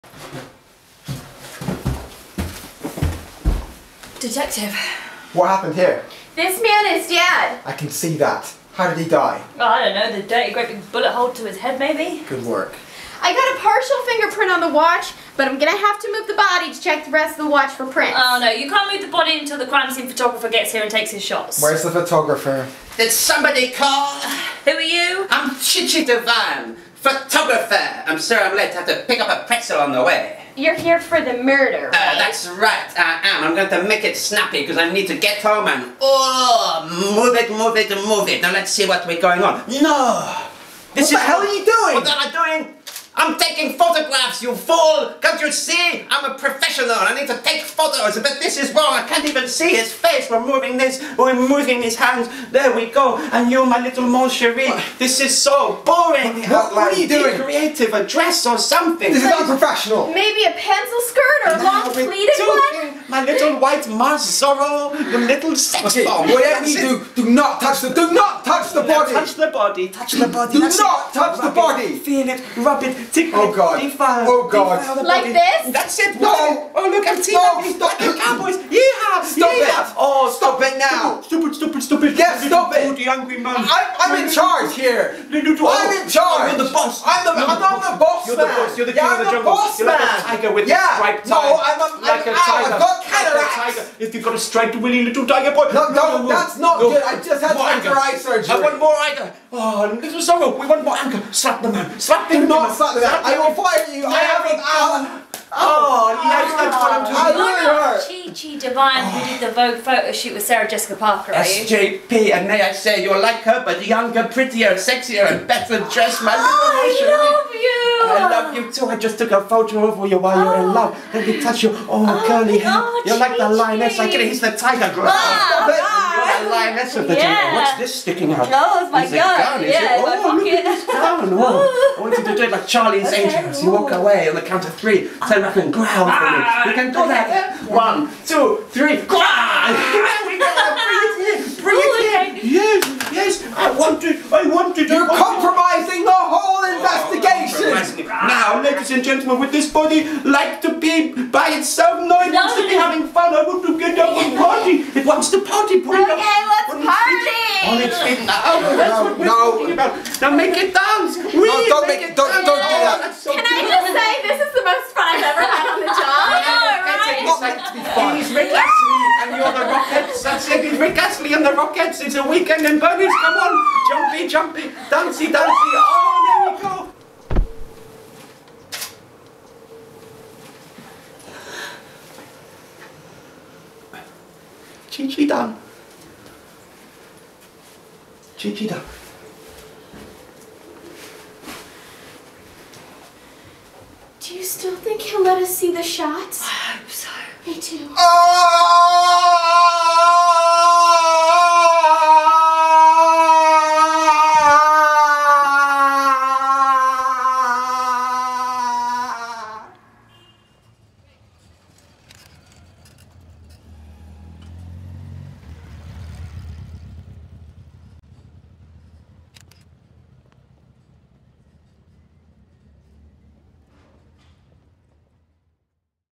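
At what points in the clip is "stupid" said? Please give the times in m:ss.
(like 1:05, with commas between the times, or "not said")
1:22.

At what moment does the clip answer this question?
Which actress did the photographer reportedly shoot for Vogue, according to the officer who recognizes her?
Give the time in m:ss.
1:50.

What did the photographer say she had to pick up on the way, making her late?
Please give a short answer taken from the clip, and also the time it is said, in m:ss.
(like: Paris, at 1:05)
A pretzel, at 0:29.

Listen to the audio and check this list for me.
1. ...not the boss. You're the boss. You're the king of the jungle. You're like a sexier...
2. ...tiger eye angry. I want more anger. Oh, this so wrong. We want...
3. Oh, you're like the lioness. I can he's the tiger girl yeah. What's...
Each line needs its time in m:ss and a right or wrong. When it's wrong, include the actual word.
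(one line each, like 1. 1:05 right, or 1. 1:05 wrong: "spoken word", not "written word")
1. 1:27 wrong: "tiger", not "sexier"
2. 1:37 wrong: "surgery", not "angry"
3. 2:02 right.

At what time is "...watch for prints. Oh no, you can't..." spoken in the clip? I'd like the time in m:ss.
0:17.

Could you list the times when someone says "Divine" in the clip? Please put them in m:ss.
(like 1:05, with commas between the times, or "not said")
0:26, 1:48.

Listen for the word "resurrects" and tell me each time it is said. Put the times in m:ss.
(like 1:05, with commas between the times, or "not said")
not said.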